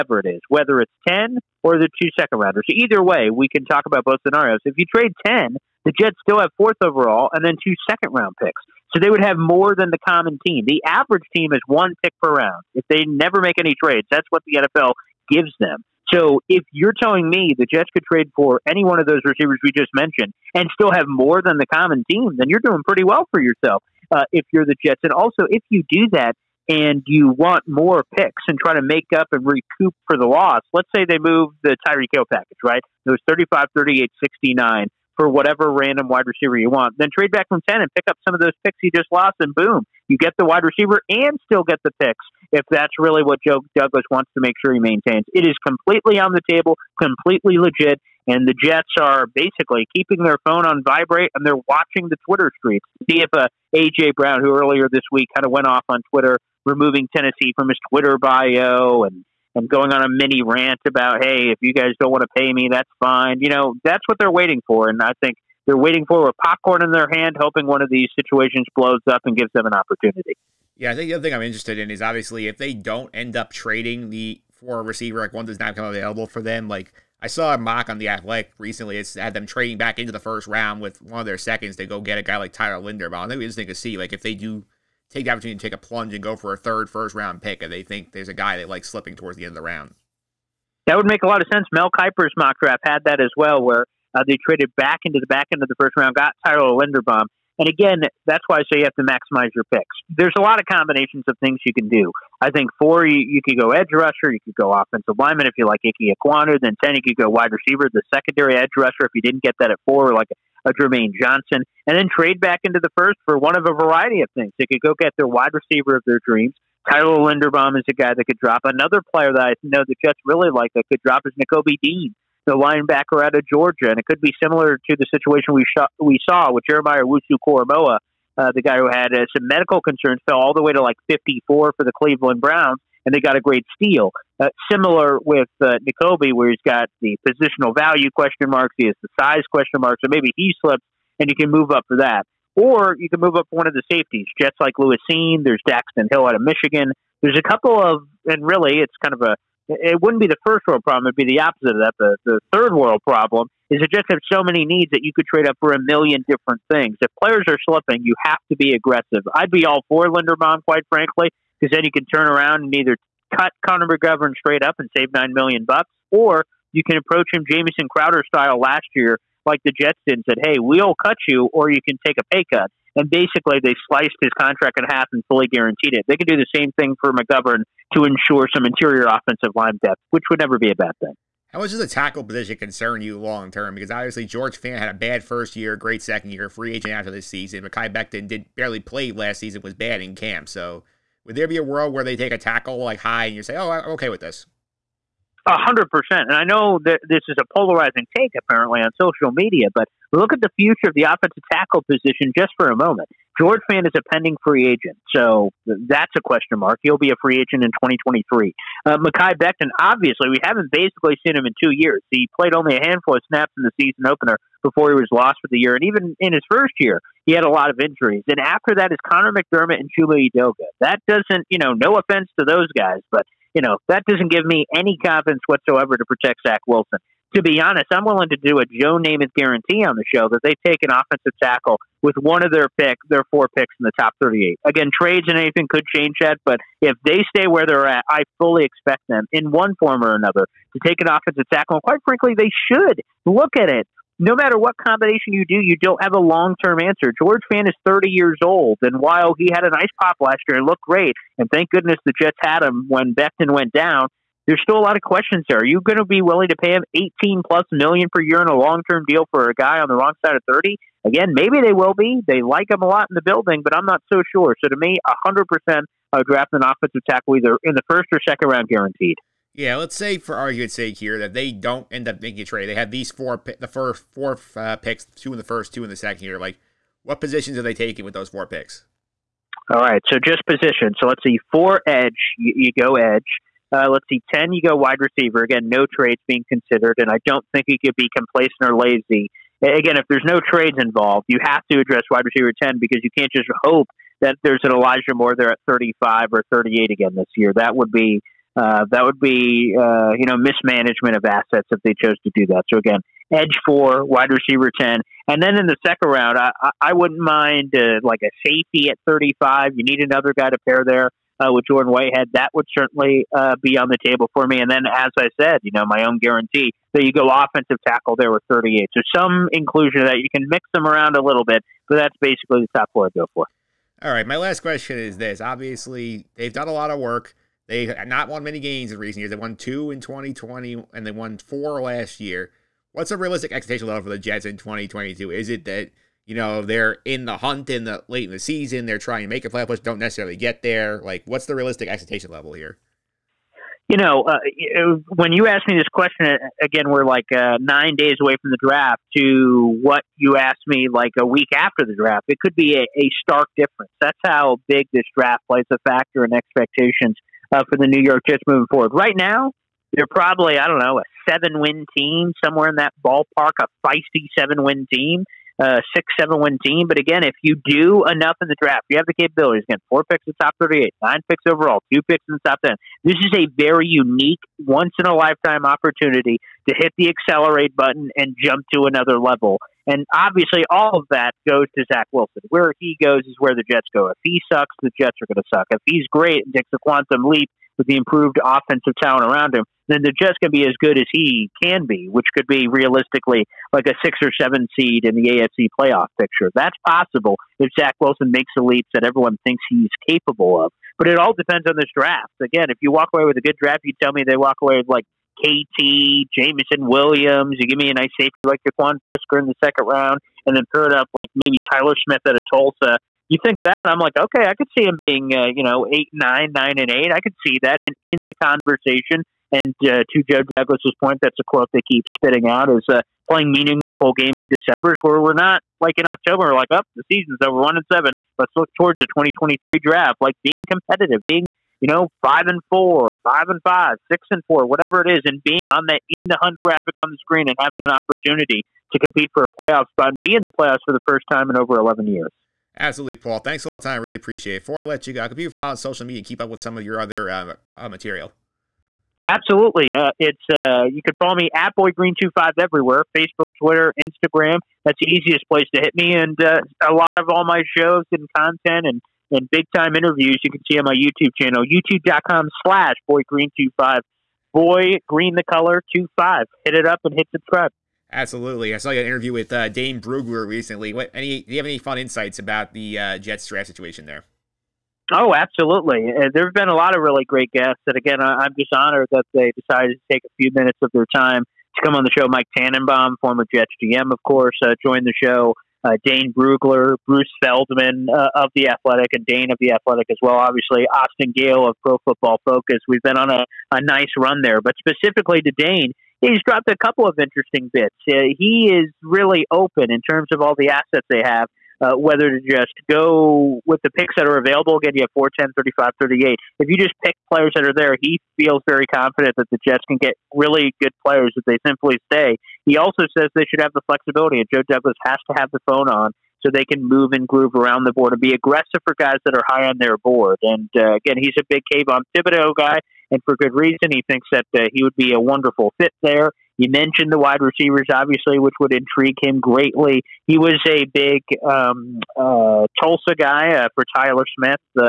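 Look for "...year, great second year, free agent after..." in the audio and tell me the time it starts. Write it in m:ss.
3:05.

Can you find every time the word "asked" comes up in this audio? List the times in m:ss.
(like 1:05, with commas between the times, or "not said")
5:45, 5:50.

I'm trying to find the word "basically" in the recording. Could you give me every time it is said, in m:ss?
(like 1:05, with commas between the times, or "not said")
0:49, 2:53, 3:30, 5:22.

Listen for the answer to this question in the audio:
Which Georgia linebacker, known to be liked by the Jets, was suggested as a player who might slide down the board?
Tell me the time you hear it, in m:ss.
2:01.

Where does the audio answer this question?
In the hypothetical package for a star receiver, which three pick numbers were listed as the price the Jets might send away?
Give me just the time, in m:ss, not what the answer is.
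0:33.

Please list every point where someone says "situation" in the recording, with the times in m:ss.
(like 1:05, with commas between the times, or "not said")
1:08, 2:05, 7:53.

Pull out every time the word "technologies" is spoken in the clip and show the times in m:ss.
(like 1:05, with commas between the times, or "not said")
not said.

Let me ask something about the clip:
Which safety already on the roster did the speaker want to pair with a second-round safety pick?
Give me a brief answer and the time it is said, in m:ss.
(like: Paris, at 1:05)
Jordan Whitehead, at 5:11.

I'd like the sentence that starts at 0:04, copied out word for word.
If you trade 10, the Jets still have fourth overall and then two second round picks.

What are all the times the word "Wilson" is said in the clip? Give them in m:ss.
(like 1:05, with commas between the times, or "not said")
3:46, 6:22, 6:37.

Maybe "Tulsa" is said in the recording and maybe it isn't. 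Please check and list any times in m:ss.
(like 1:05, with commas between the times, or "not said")
6:52, 8:52.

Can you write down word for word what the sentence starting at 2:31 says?
The, the third world problem is the Jets have so many needs that you could trade up for a million different things.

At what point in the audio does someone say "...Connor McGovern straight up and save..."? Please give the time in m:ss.
2:43.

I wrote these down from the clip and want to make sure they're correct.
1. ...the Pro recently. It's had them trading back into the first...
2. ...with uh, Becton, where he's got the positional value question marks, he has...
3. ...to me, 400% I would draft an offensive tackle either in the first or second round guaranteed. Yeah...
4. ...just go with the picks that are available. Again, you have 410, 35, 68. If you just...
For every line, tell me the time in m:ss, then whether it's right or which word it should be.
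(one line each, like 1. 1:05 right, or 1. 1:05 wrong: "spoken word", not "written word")
1. 1:17 wrong: "Athletic", not "Pro"
2. 2:15 wrong: "Nakobe", not "Becton"
3. 4:24 wrong: "100", not "400"
4. 8:22 wrong: "38", not "68".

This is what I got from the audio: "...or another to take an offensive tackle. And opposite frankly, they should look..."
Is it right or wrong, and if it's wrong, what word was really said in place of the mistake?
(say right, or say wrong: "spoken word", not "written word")
wrong: "quite", not "opposite".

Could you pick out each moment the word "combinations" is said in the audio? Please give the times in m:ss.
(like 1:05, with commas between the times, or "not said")
1:40, 4:04.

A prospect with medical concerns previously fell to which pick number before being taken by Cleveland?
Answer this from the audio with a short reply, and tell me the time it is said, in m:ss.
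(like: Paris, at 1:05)
54, at 2:11.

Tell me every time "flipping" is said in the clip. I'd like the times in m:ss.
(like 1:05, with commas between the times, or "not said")
not said.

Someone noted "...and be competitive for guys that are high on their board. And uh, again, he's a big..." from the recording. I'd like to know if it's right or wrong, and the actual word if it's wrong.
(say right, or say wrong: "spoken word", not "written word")
wrong: "aggressive", not "competitive".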